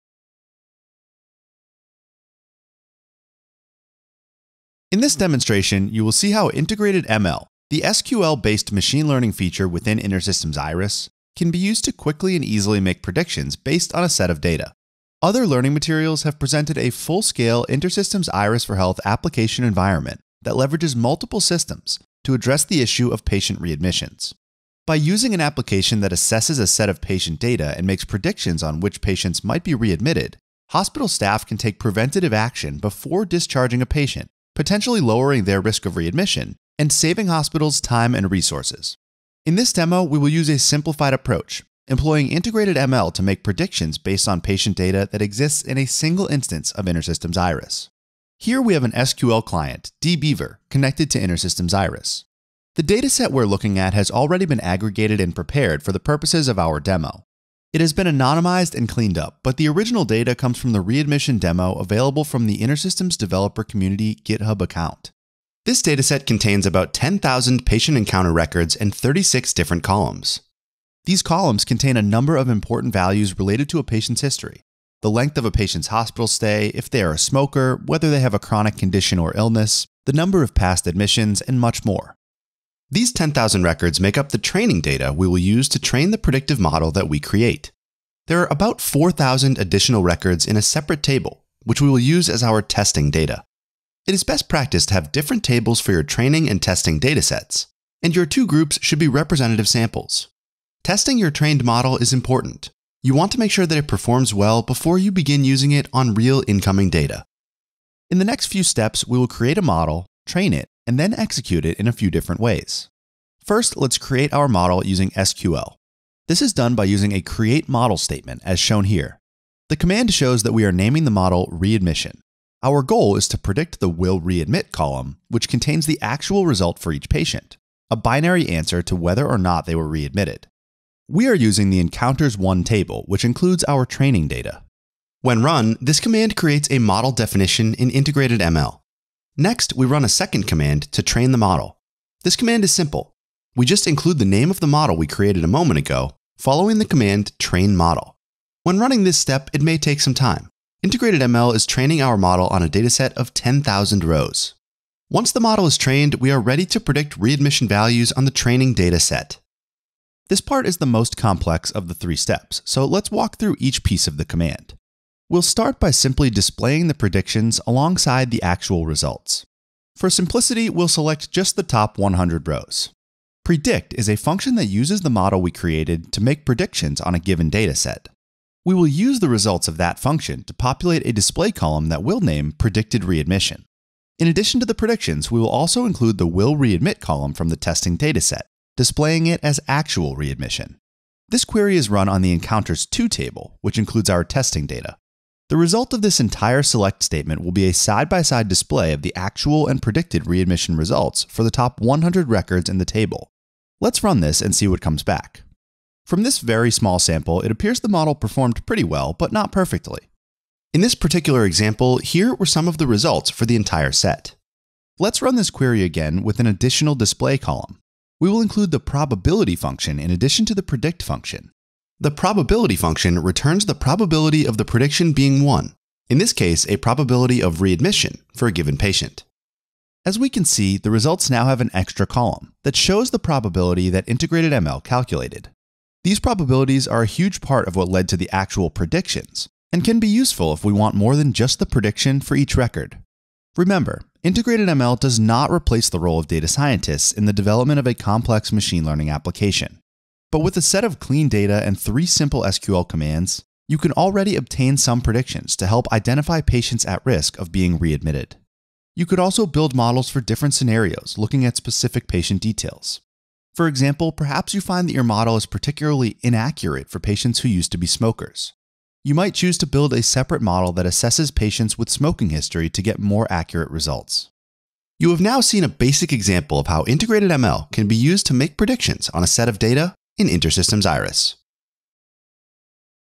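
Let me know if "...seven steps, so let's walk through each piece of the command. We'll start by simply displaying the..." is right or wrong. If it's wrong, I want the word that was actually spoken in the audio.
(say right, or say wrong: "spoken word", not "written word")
wrong: "three", not "seven".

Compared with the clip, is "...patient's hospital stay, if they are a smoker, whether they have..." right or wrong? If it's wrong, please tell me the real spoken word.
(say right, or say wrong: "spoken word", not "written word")
right.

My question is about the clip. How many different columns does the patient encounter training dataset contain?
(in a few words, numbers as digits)
36.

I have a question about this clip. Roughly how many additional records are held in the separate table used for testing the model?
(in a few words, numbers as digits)
4,000.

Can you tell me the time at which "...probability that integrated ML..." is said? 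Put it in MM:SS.
03:53.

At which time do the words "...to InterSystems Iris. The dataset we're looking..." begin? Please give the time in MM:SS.
00:51.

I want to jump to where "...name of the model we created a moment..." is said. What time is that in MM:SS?
02:24.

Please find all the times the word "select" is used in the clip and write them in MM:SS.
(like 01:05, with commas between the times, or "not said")
02:50, 03:16.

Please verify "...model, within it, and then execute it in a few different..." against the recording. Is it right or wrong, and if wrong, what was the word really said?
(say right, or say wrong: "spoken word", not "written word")
wrong: "train", not "within".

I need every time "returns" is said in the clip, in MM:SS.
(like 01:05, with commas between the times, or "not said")
03:43.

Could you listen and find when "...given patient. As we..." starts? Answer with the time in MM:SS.
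03:48.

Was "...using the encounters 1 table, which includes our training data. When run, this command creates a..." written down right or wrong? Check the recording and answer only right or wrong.
right.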